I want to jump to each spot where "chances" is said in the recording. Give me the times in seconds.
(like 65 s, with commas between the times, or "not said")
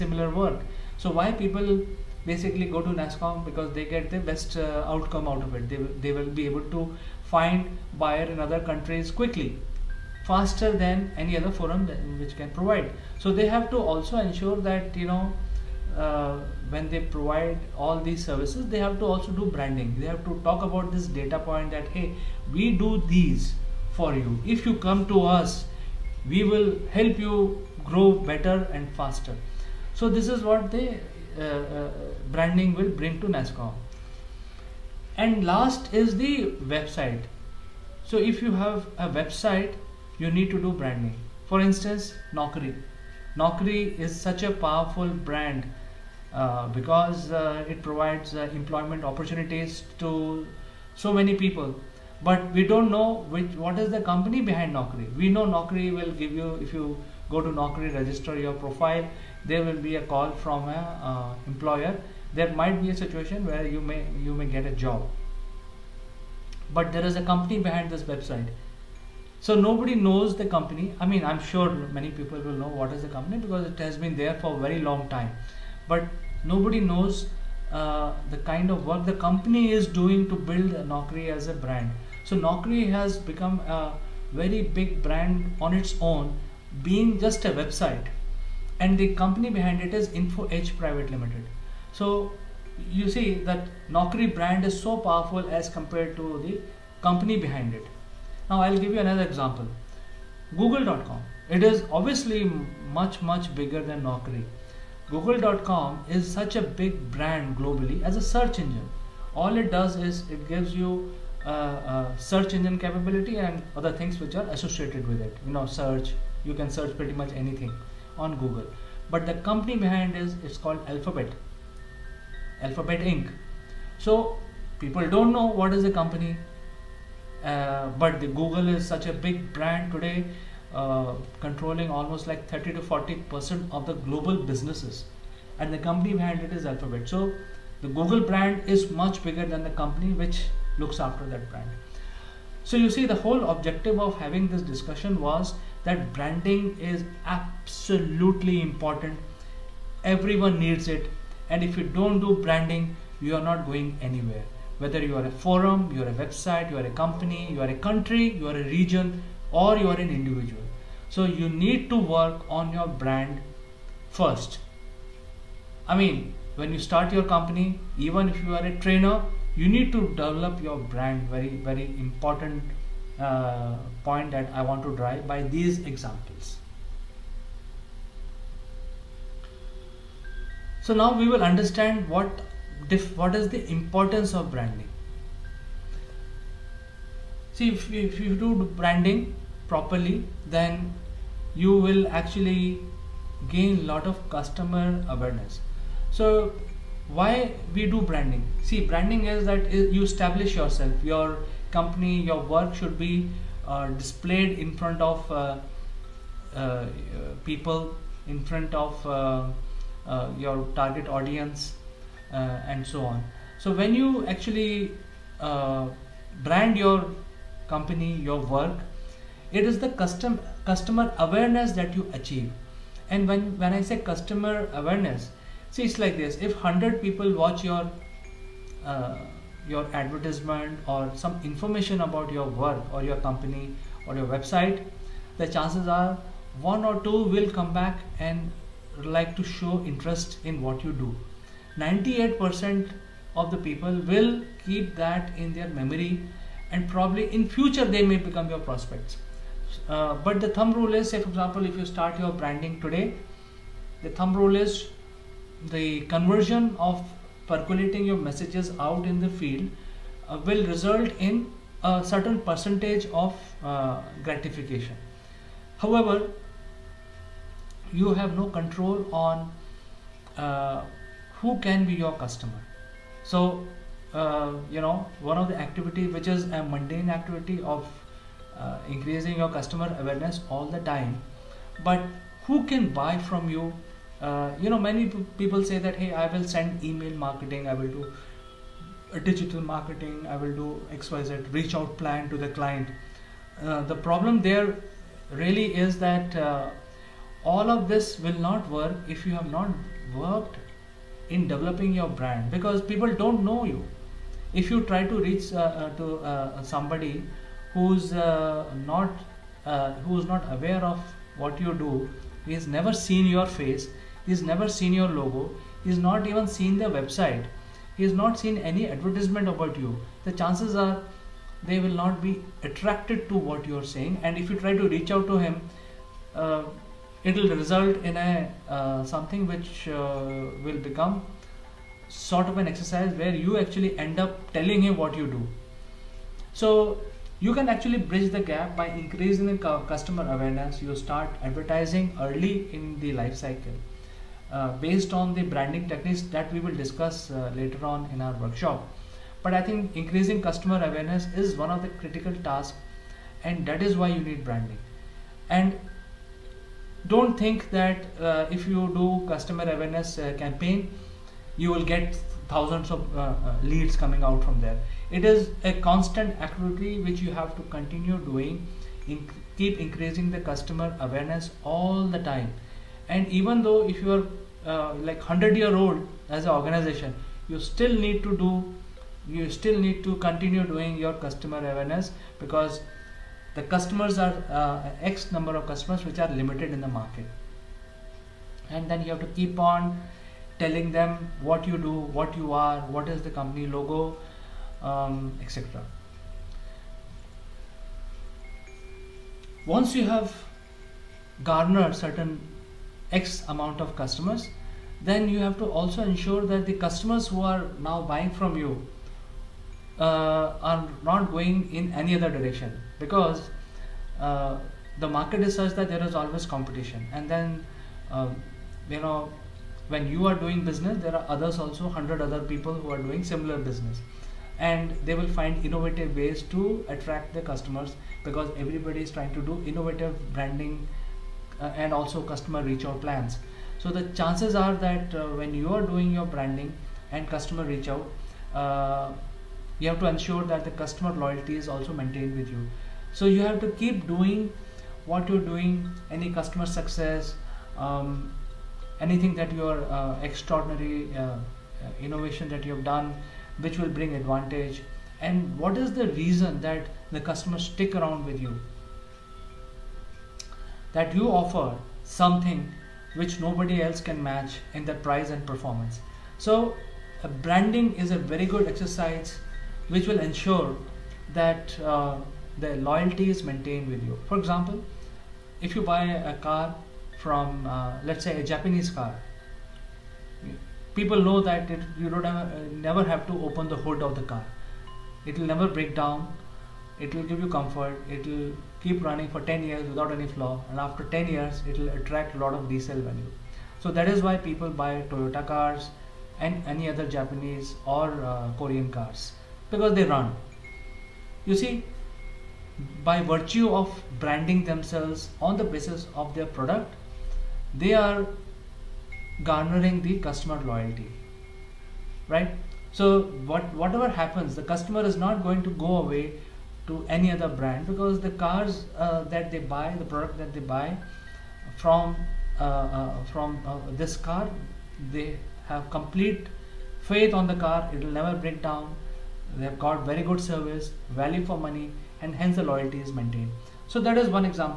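235 s, 320 s, 434 s.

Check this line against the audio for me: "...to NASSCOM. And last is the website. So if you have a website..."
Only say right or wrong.
right.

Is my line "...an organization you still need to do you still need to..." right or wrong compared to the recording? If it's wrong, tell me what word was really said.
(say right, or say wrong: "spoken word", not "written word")
right.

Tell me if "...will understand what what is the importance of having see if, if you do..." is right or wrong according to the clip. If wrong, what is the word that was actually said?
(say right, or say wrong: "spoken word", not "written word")
wrong: "branding", not "having".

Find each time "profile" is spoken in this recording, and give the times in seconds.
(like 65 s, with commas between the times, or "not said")
58 s.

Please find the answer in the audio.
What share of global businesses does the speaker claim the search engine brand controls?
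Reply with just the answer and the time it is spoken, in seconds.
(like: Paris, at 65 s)
30 to 40 percent, at 132 s.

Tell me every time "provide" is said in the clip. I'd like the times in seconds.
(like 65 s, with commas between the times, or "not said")
12 s, 17 s, 47 s.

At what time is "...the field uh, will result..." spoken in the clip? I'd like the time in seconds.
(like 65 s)
259 s.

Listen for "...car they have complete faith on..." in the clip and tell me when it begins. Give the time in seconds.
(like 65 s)
524 s.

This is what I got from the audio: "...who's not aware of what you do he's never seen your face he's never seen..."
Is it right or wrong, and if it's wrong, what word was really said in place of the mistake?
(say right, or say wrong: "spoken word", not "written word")
right.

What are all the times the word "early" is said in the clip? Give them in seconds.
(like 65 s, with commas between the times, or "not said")
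342 s.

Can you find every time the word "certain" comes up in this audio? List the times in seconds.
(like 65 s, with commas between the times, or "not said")
262 s, 401 s.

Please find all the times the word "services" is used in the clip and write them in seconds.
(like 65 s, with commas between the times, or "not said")
18 s, 530 s.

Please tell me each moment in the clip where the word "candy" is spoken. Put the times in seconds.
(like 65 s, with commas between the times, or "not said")
not said.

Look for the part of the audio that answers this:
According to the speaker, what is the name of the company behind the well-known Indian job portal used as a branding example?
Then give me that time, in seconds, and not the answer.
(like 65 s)
90 s.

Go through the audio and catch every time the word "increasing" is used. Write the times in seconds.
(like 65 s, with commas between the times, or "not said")
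278 s, 338 s, 350 s, 369 s.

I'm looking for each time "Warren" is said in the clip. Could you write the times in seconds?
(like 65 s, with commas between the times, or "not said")
not said.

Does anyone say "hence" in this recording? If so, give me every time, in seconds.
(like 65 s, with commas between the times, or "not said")
532 s.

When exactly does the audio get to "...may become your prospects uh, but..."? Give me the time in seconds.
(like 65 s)
248 s.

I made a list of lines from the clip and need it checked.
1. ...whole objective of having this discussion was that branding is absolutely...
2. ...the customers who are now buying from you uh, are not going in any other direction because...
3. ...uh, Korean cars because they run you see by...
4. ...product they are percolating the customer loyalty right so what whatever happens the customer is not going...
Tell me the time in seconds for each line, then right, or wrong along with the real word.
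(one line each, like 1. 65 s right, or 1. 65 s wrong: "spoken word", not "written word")
1. 143 s right
2. 406 s right
3. 498 s right
4. 506 s wrong: "garnering", not "percolating".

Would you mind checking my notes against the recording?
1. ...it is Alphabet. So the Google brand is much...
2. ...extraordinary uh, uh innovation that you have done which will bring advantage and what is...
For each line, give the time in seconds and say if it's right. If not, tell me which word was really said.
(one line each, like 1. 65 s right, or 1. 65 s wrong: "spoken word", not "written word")
1. 136 s right
2. 450 s right.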